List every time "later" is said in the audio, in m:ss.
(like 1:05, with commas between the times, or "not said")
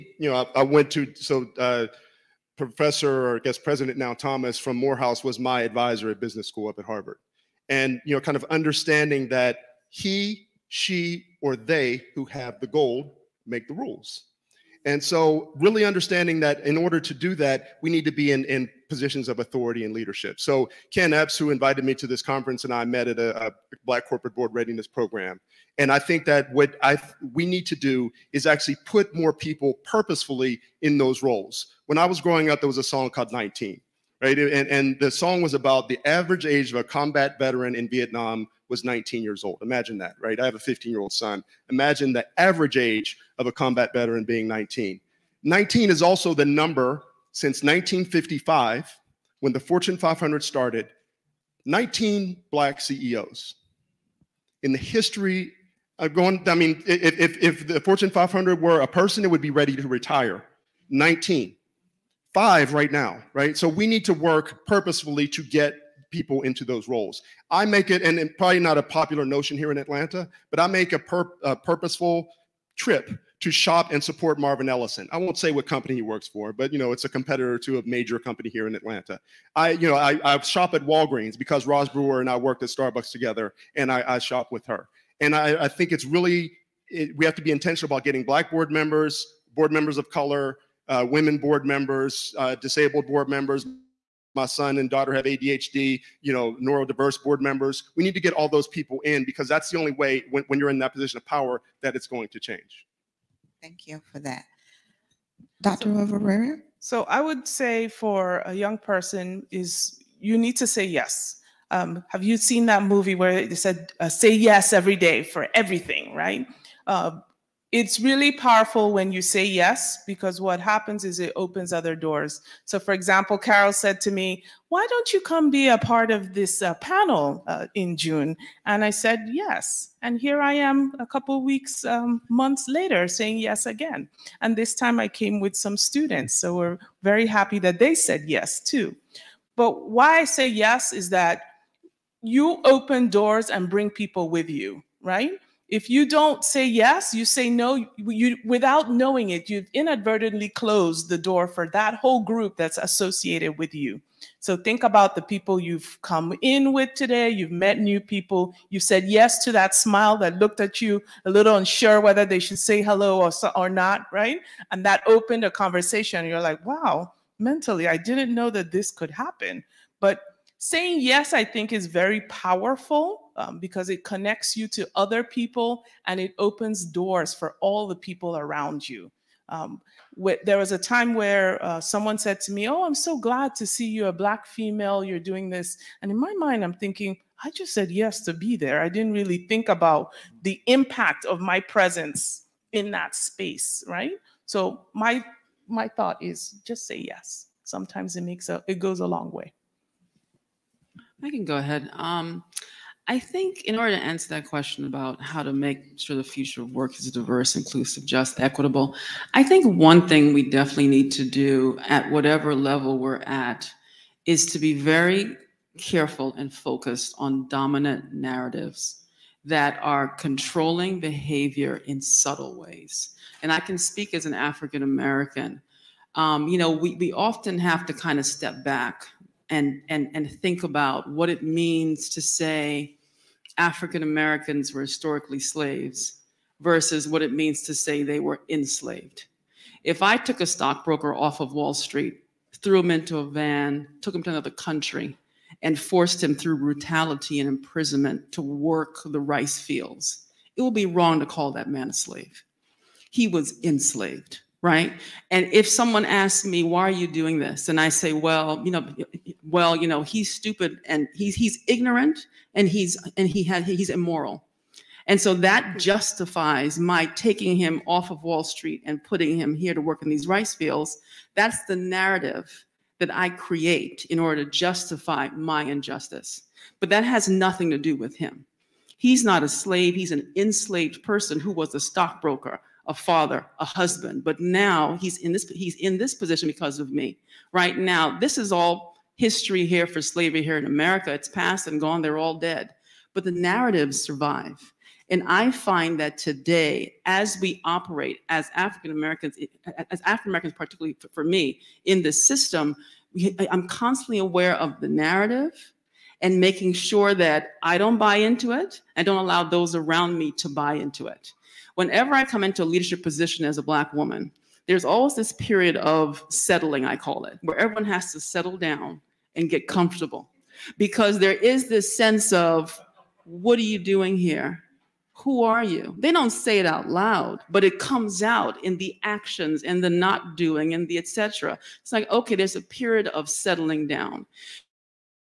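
2:12.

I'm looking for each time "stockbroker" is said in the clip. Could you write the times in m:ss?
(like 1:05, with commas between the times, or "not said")
4:00, 4:41.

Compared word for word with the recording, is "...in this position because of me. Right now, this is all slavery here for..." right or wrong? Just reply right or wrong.
wrong.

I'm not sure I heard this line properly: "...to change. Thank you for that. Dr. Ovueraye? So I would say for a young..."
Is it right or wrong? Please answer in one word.
right.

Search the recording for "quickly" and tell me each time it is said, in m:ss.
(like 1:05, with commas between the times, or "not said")
not said.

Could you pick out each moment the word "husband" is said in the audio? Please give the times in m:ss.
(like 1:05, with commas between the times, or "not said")
4:43.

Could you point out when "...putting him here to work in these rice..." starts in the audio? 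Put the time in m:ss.
4:29.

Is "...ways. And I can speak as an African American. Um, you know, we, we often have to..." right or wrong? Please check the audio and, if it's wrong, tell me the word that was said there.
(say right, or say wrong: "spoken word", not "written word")
right.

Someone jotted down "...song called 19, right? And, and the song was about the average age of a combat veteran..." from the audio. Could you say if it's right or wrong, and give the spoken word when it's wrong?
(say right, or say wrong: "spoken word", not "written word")
right.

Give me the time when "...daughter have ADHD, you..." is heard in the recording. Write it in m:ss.
1:34.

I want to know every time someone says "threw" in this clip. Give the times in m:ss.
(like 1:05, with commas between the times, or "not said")
4:02.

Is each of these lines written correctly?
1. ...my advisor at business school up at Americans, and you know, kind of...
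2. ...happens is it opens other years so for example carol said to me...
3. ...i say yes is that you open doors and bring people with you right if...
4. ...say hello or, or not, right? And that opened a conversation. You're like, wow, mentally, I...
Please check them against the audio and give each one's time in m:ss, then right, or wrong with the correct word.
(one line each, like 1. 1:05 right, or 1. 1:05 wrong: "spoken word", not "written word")
1. 0:05 wrong: "Harvard", not "Americans"
2. 2:00 wrong: "doors", not "years"
3. 2:20 right
4. 2:42 right.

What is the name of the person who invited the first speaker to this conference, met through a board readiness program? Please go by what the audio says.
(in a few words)
Ken Epps.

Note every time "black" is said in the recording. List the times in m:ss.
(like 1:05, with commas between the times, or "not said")
0:23, 0:52, 1:28, 3:04, 5:13.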